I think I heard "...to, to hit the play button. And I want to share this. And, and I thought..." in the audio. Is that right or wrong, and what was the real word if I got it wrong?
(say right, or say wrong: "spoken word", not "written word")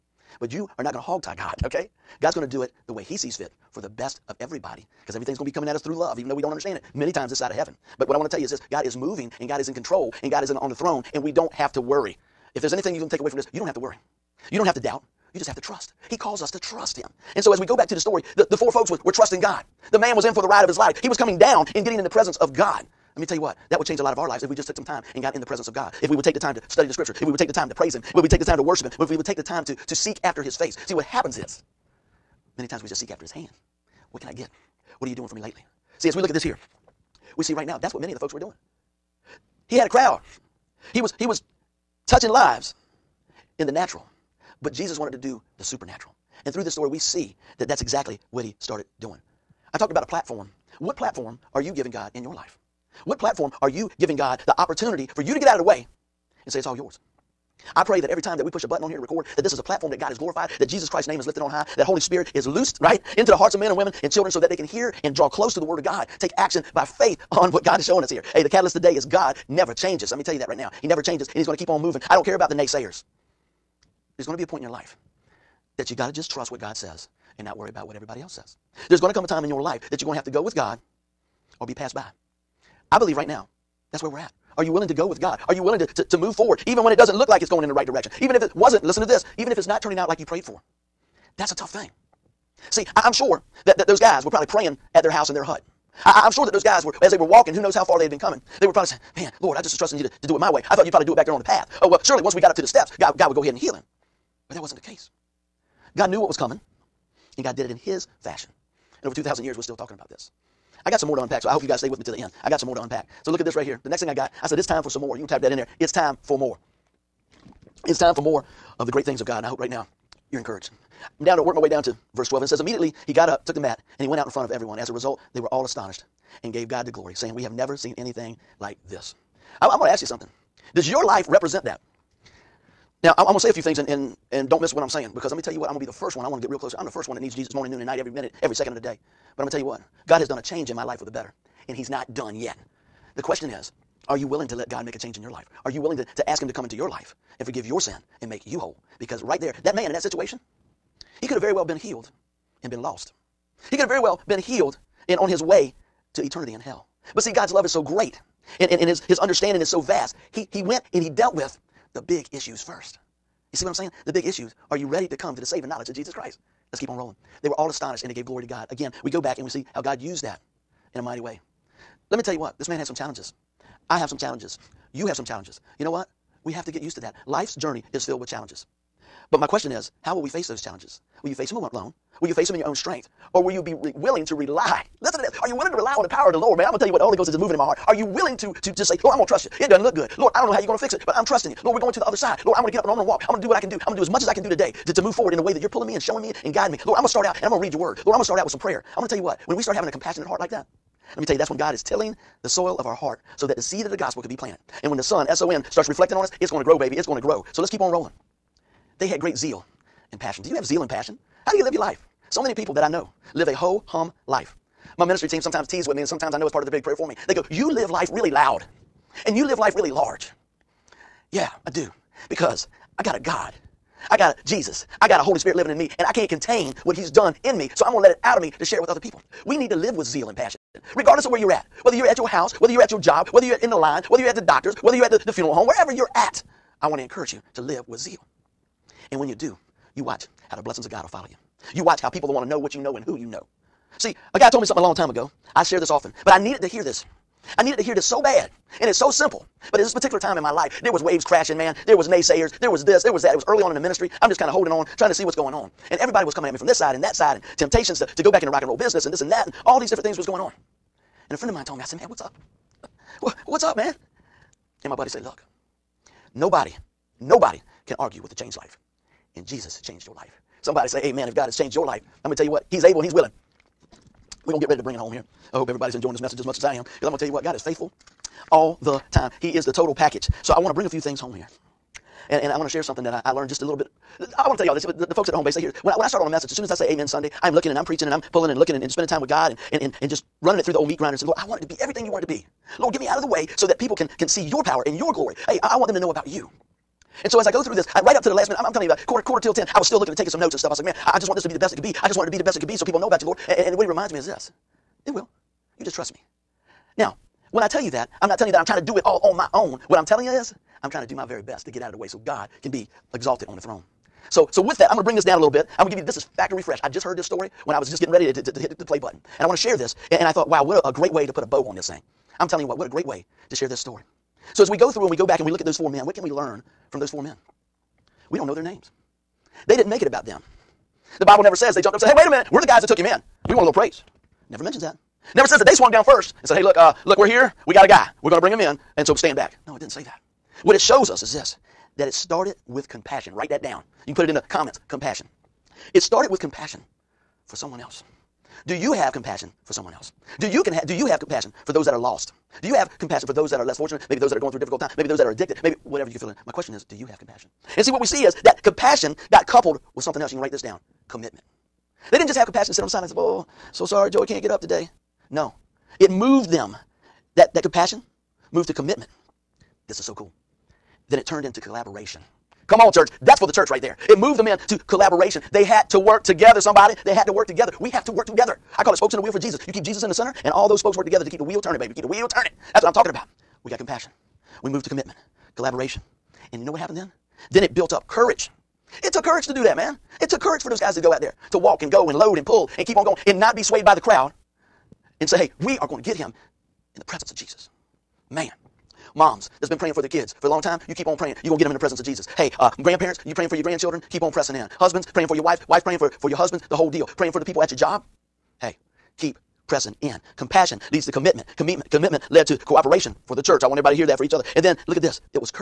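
right.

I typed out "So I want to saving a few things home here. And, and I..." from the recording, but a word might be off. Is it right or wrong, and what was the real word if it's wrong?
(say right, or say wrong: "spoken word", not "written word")
wrong: "bring", not "saving".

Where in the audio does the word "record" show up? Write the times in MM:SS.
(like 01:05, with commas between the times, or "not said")
00:58.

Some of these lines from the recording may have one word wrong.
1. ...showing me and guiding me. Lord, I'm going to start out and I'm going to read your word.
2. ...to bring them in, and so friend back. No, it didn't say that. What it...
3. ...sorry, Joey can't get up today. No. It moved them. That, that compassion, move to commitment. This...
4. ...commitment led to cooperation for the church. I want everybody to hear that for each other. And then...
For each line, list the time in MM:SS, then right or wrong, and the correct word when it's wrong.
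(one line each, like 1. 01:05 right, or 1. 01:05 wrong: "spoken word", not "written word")
1. 03:16 right
2. 05:38 wrong: "stand", not "friend"
3. 06:03 right
4. 06:51 right.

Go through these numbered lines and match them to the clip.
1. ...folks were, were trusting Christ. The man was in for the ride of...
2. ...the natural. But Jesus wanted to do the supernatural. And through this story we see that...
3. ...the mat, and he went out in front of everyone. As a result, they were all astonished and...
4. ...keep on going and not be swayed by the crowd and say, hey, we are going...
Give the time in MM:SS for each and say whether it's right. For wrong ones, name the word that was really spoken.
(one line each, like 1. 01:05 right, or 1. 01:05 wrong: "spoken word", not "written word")
1. 00:18 wrong: "God", not "Christ"
2. 00:43 right
3. 02:03 right
4. 06:32 right.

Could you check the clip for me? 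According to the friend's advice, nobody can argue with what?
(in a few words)
a changed life.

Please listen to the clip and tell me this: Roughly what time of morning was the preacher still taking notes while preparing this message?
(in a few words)
quarter till 10.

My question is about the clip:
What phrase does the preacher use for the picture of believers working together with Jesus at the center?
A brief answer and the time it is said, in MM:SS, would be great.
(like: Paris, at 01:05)
spokes in the wheel for Jesus, at 06:18.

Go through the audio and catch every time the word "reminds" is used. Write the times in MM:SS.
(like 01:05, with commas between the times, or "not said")
05:03.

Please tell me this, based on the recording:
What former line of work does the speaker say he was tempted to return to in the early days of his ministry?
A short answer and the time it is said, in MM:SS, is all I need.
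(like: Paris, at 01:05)
rock and roll business, at 04:18.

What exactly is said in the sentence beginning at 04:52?
Lord, get me out of the way so that people can, can see your power and your glory.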